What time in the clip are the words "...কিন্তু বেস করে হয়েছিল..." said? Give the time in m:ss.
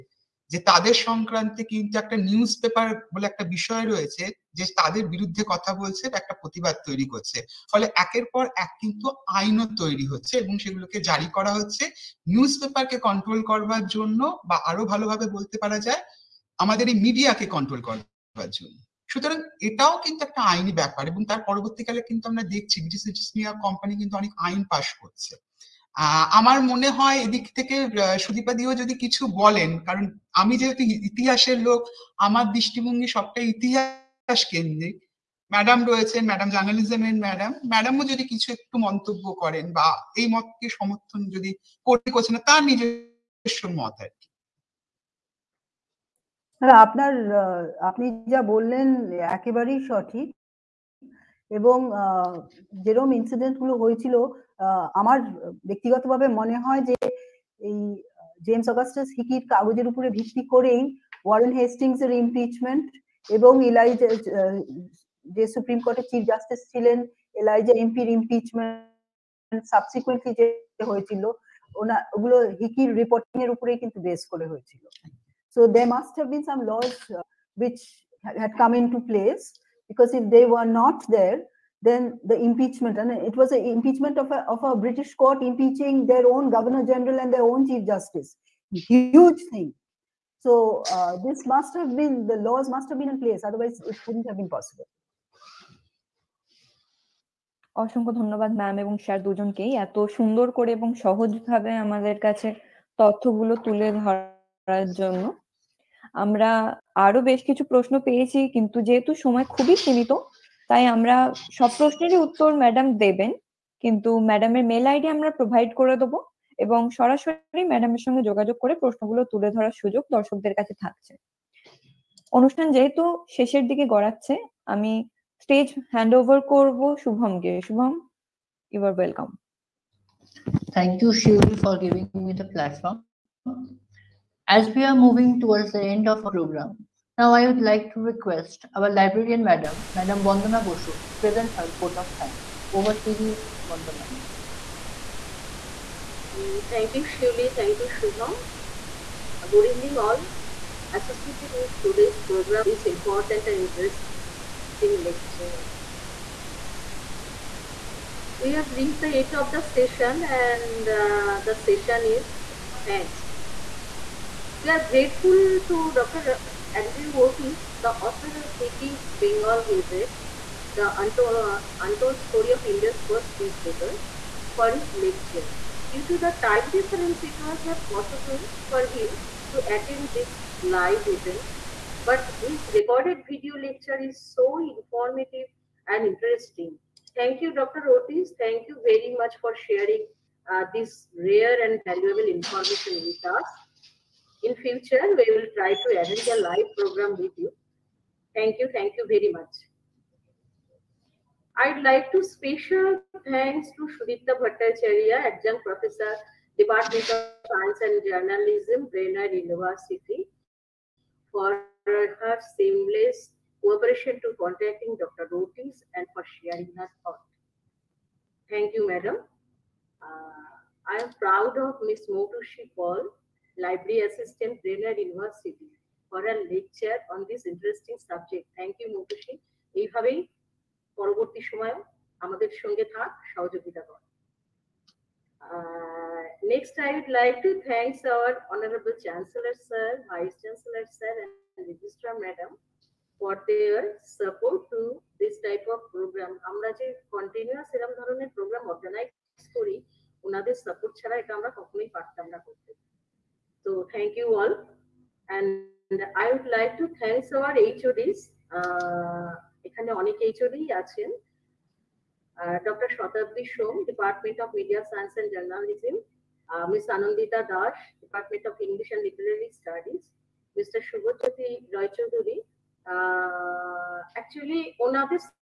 1:13.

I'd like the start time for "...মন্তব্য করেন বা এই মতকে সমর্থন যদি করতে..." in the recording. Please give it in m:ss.
0:38.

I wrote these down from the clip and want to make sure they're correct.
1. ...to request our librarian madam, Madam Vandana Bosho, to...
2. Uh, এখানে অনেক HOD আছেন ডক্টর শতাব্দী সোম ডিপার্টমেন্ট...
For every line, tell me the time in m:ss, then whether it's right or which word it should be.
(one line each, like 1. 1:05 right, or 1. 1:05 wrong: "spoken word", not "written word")
1. 2:17 right
2. 4:18 right.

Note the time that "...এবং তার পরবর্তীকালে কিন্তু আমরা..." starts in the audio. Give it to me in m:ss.
0:21.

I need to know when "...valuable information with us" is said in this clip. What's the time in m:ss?
3:11.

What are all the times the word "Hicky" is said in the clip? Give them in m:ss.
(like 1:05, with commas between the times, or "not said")
2:48.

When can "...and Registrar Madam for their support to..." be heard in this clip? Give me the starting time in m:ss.
4:01.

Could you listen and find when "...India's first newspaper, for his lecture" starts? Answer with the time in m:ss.
2:52.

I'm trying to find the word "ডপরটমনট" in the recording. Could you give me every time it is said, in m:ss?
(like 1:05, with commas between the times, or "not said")
4:23, 4:28.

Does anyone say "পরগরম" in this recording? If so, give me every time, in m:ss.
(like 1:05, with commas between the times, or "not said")
2:16, 4:08.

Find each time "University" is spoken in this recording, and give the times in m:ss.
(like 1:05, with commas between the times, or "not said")
3:29, 3:44.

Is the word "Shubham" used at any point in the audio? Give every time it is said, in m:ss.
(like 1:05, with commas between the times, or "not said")
2:27.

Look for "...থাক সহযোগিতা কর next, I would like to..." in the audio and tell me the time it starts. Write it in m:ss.
3:52.